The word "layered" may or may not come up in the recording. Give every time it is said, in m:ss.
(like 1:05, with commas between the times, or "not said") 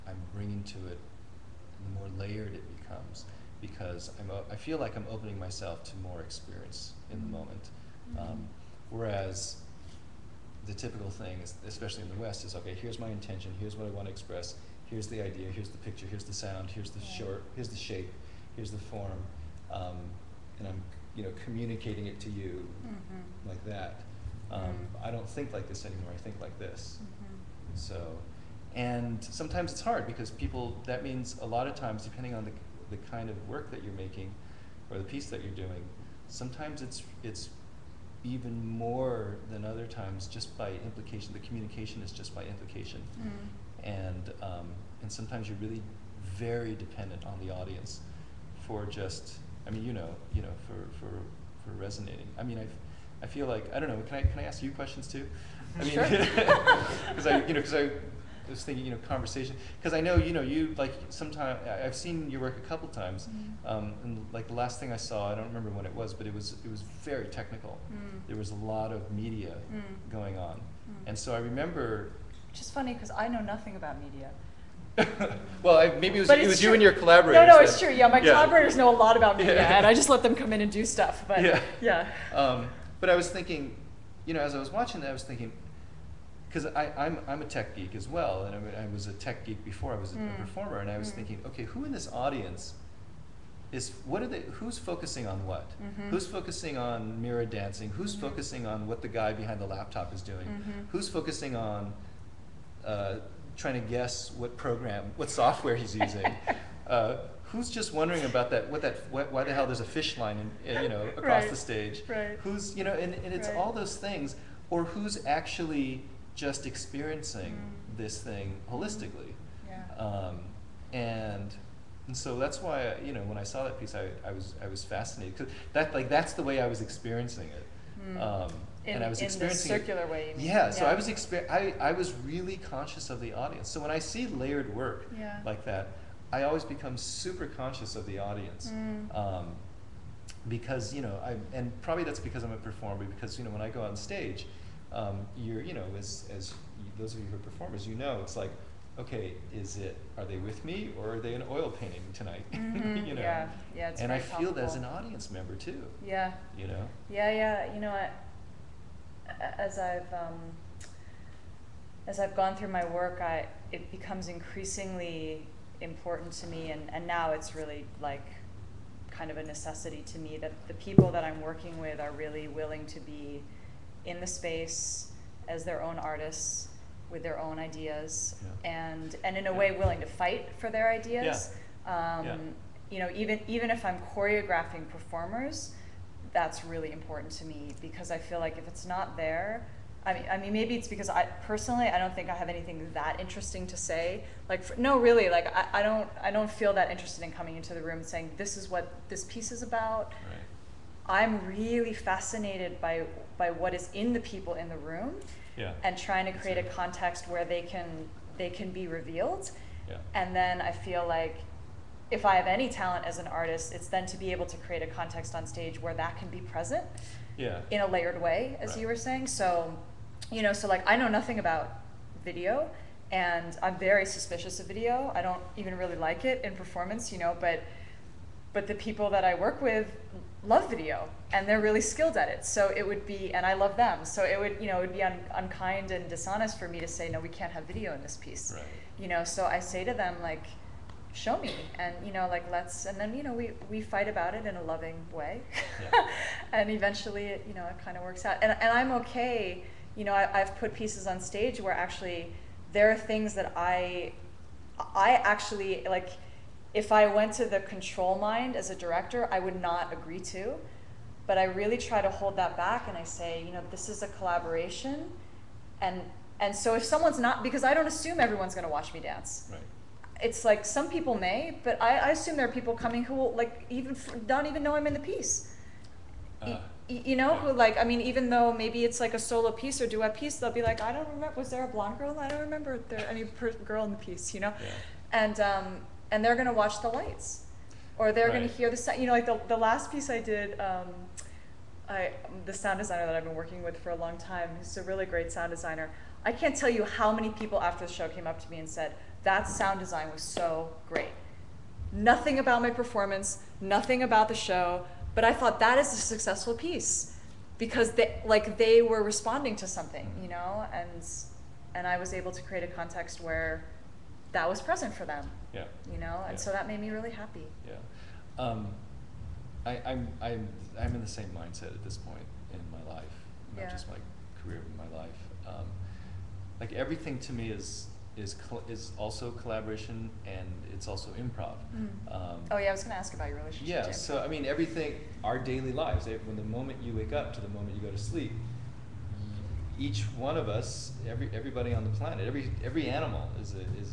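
0:02, 2:14, 3:37.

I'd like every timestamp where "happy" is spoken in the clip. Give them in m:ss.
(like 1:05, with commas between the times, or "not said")
5:17.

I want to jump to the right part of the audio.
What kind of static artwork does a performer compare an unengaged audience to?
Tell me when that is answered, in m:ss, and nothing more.
2:31.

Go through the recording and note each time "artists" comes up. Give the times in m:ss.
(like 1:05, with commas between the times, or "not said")
2:55, 3:33.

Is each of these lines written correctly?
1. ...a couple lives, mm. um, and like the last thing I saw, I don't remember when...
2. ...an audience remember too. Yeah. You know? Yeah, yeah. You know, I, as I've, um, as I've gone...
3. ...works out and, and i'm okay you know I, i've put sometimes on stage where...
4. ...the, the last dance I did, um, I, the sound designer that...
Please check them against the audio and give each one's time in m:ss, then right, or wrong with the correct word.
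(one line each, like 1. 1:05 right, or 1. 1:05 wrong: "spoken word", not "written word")
1. 1:02 wrong: "times", not "lives"
2. 2:34 wrong: "member", not "remember"
3. 4:08 wrong: "pieces", not "sometimes"
4. 4:49 wrong: "piece", not "dance".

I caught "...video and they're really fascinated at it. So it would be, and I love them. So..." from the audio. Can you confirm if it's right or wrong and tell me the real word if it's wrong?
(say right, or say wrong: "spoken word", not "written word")
wrong: "skilled", not "fascinated".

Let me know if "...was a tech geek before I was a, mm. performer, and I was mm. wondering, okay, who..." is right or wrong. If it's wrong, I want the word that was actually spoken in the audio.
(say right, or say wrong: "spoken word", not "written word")
wrong: "thinking", not "wondering".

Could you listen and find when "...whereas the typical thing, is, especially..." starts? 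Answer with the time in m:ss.
0:08.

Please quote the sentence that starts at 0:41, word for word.
The communication is just by implication.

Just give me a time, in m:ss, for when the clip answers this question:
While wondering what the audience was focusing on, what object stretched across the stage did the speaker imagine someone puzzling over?
1:49.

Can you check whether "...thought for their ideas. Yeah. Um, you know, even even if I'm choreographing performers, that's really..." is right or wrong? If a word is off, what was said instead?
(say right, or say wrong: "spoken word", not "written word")
wrong: "fight", not "thought".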